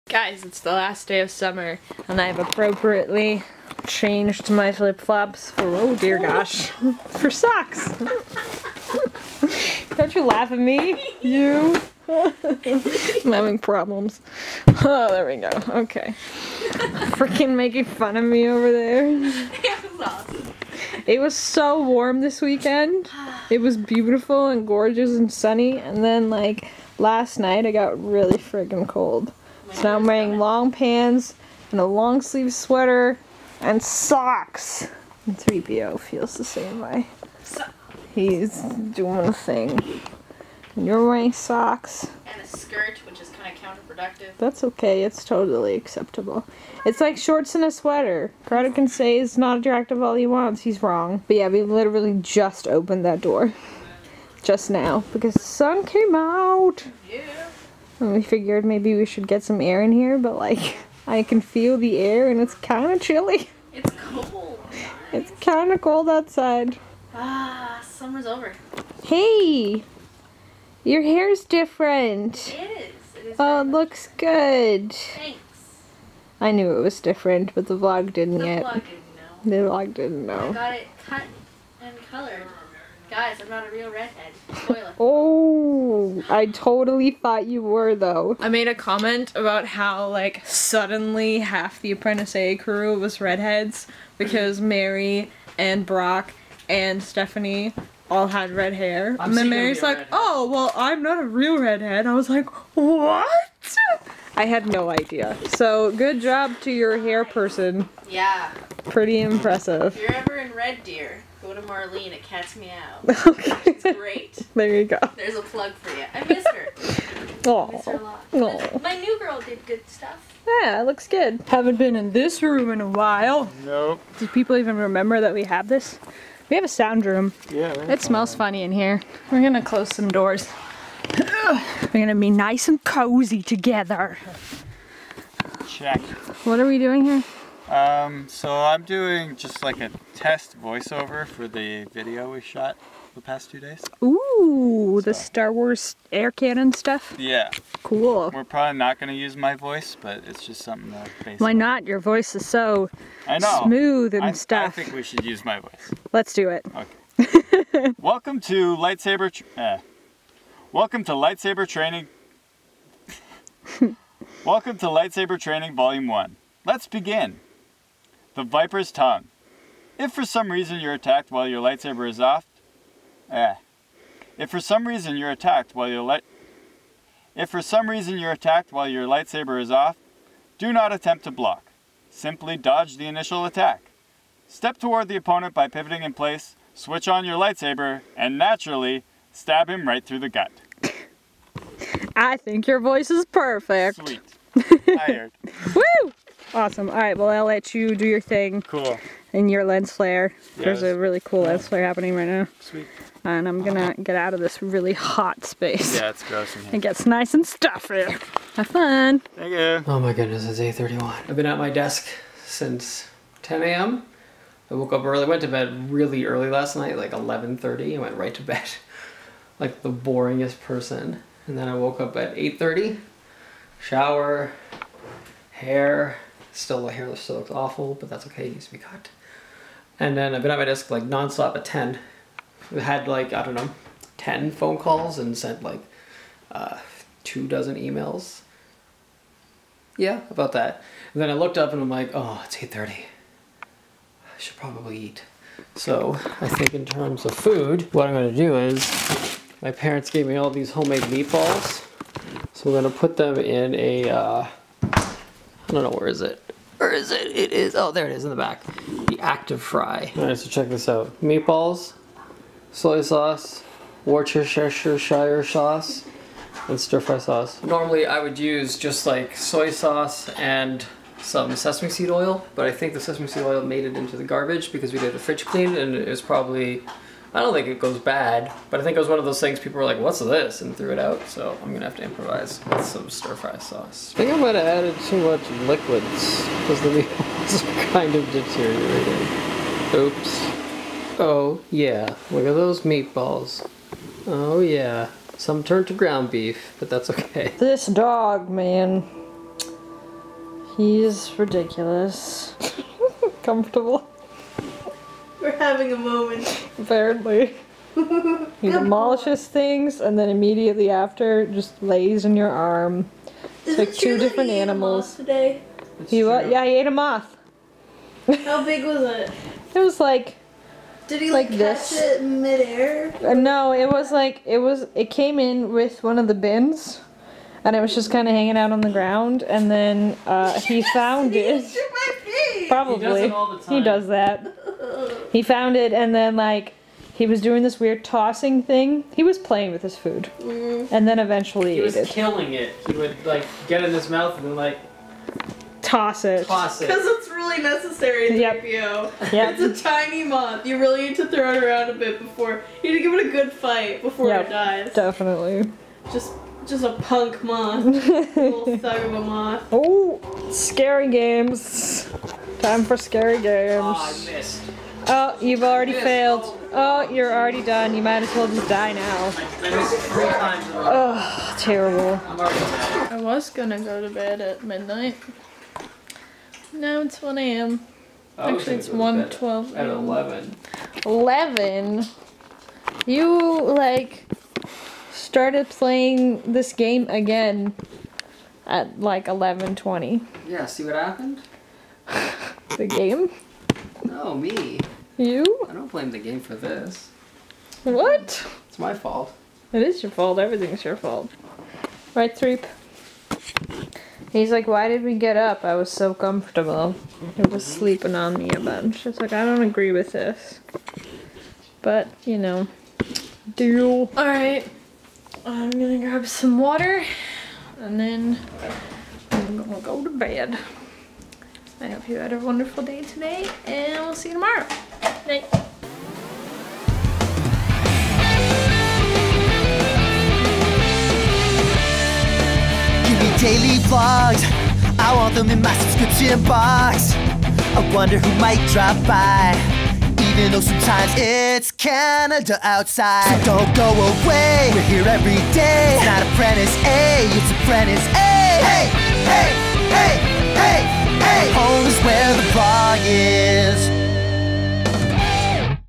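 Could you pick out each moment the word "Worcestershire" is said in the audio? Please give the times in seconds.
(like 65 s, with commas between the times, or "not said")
264 s.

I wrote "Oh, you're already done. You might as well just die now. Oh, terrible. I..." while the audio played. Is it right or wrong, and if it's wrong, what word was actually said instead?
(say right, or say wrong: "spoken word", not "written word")
right.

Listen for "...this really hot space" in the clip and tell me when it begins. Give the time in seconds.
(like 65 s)
204 s.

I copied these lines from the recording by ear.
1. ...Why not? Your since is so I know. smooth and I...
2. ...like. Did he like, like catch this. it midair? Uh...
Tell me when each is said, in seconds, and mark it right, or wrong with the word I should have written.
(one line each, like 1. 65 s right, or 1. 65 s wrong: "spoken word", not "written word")
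1. 151 s wrong: "voice", not "since"
2. 319 s right.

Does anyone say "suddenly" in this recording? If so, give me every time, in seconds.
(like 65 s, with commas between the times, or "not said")
90 s.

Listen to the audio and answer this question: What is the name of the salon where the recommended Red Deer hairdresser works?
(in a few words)
Cat's Meow.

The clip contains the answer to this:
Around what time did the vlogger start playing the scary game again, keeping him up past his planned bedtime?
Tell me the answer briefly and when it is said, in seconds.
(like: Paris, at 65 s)
11:20, at 389 s.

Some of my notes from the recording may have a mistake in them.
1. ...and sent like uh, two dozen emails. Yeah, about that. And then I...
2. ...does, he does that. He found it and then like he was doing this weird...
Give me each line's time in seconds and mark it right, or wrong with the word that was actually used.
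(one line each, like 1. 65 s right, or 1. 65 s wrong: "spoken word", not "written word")
1. 235 s right
2. 333 s right.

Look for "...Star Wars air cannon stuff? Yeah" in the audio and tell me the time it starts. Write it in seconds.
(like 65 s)
145 s.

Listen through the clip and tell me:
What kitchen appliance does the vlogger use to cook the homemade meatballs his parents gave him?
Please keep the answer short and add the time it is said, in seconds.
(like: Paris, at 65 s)
ActiFry, at 259 s.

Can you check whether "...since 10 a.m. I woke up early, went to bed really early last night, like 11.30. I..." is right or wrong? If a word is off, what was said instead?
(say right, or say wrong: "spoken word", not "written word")
right.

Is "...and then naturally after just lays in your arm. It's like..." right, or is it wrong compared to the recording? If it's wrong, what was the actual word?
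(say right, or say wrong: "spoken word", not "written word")
wrong: "immediately", not "naturally".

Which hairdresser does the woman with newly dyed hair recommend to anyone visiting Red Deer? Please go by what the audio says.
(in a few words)
Marlene.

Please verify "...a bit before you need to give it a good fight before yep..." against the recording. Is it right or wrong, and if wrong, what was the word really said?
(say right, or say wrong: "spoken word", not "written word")
right.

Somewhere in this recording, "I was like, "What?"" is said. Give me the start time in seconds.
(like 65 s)
102 s.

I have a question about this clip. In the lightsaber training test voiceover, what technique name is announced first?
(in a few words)
The Viper's Tongue.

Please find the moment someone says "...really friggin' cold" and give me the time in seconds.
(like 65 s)
28 s.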